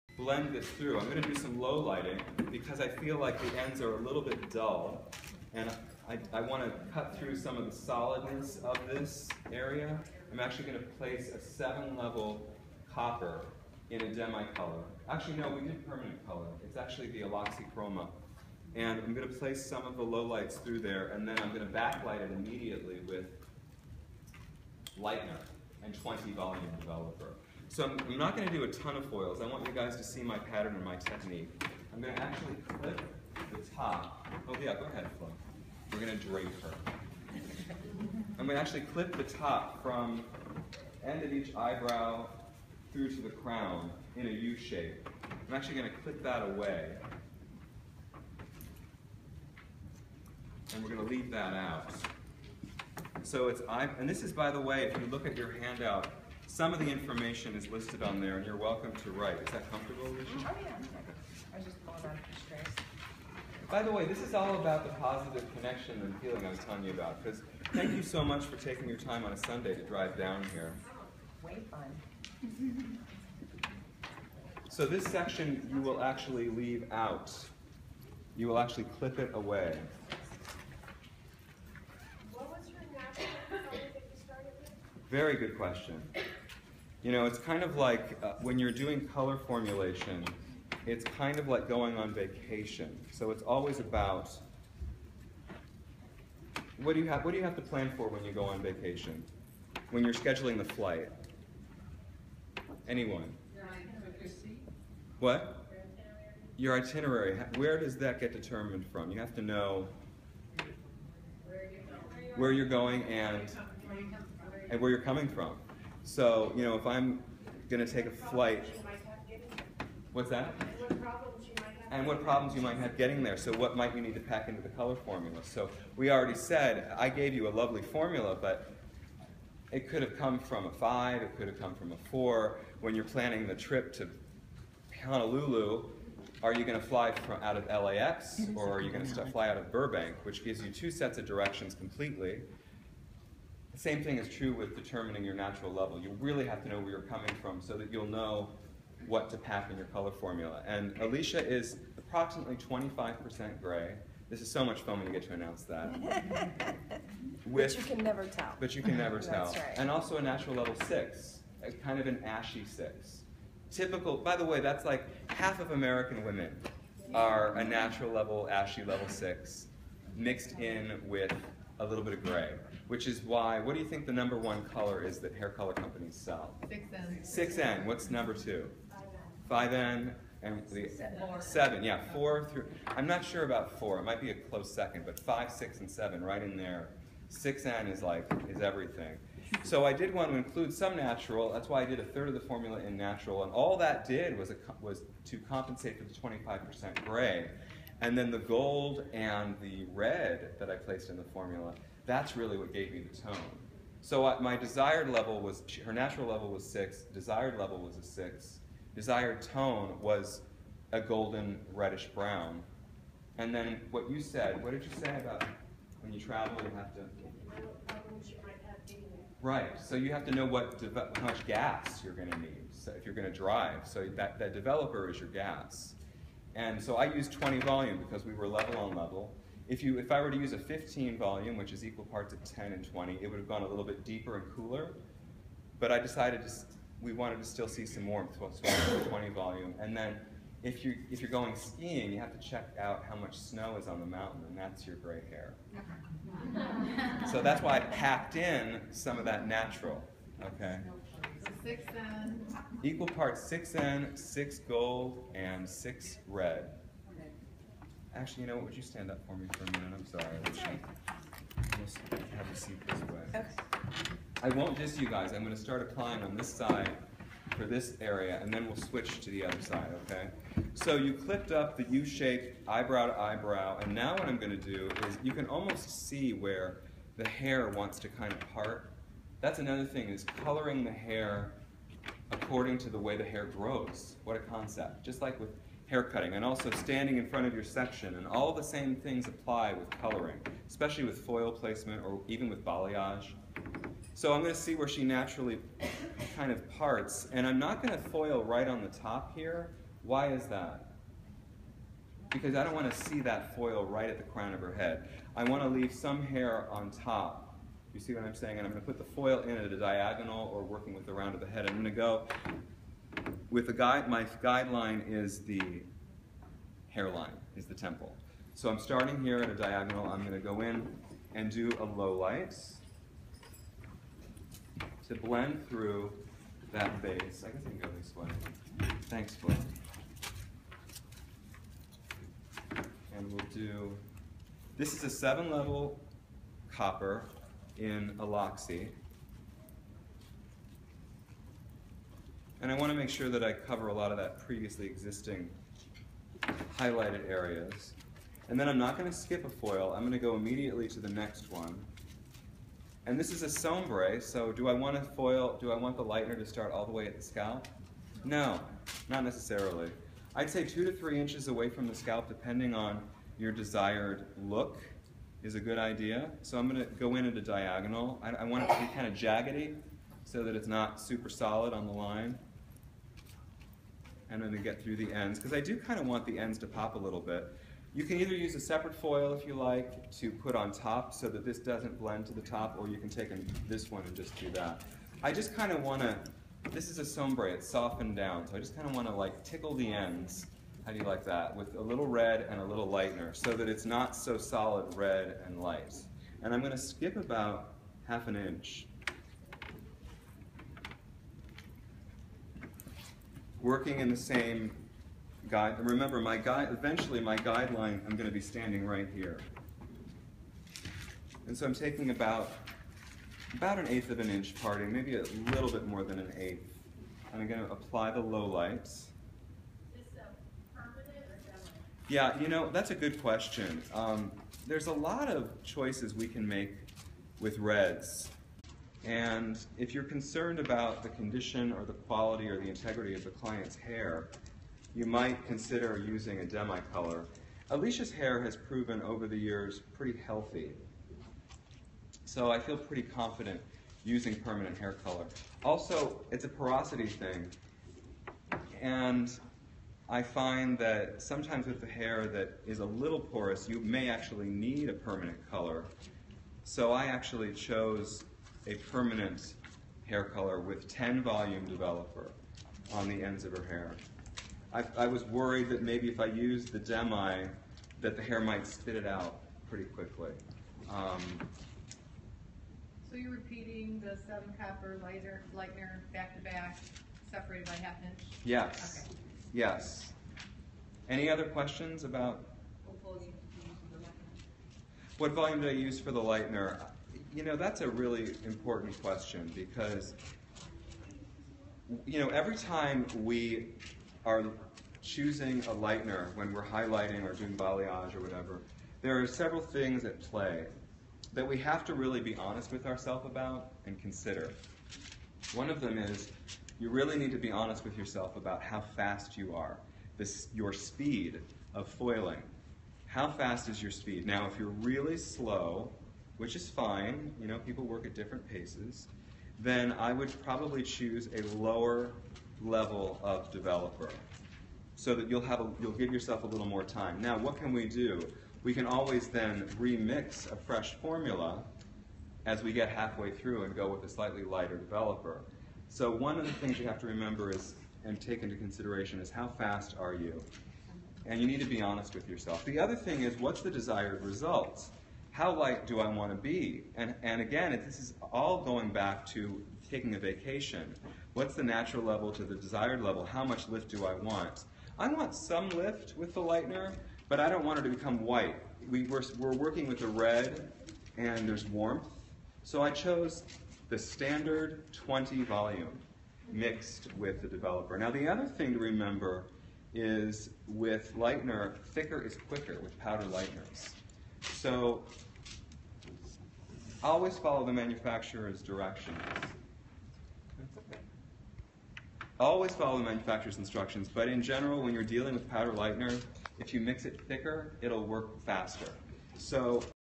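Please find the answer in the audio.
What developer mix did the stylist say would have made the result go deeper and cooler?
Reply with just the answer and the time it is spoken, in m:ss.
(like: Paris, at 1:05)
15 volume, at 3:50.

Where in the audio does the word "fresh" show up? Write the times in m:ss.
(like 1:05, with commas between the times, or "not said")
8:50.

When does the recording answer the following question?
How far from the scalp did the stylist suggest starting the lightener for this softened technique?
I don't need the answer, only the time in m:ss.
6:00.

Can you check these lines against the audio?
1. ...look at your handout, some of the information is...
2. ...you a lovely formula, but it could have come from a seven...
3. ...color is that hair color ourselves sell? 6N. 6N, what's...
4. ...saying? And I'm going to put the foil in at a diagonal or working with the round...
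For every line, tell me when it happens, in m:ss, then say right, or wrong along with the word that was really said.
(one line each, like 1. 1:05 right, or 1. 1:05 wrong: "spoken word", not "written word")
1. 0:55 right
2. 2:07 wrong: "five", not "seven"
3. 2:54 wrong: "companies", not "ourselves"
4. 5:08 right.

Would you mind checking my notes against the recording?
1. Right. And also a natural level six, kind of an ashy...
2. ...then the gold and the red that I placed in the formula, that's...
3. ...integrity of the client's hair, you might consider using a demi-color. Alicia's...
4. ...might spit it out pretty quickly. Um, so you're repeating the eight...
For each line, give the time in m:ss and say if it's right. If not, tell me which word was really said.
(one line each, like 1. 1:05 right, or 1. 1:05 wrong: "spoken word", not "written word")
1. 2:39 right
2. 3:18 right
3. 7:12 right
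4. 7:48 wrong: "seven", not "eight".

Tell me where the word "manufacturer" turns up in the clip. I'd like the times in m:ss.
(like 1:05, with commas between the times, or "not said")
9:37, 9:43.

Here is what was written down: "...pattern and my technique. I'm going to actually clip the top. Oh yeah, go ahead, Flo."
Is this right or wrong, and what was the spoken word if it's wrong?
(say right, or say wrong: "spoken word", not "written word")
right.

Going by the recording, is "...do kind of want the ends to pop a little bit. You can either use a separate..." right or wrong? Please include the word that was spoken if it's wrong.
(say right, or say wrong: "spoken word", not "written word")
right.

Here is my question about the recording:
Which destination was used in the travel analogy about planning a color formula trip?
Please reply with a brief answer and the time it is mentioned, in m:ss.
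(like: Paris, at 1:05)
Honolulu, at 2:15.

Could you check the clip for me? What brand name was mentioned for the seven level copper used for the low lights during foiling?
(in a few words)
Aloxi.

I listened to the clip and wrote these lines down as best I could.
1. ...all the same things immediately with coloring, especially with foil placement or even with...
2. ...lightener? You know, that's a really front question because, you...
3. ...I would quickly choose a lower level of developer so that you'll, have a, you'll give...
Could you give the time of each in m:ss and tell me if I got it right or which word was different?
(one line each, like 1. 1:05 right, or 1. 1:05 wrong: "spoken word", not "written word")
1. 4:48 wrong: "apply", not "immediately"
2. 8:06 wrong: "important", not "front"
3. 8:39 wrong: "probably", not "quickly".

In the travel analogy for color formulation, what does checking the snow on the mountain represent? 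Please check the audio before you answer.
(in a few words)
gray hair.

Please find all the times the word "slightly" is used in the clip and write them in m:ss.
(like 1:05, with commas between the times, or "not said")
8:54.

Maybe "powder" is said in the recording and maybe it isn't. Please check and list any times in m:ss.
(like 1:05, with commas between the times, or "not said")
9:32, 9:45.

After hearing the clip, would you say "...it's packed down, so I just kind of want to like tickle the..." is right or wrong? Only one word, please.
wrong.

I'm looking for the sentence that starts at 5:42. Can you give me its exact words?
And I want to make sure that I cover a lot of that previously existing highlighted areas.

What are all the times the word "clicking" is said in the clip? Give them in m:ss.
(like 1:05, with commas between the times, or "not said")
not said.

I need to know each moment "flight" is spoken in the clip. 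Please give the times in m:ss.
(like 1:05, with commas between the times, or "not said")
1:40, 1:58.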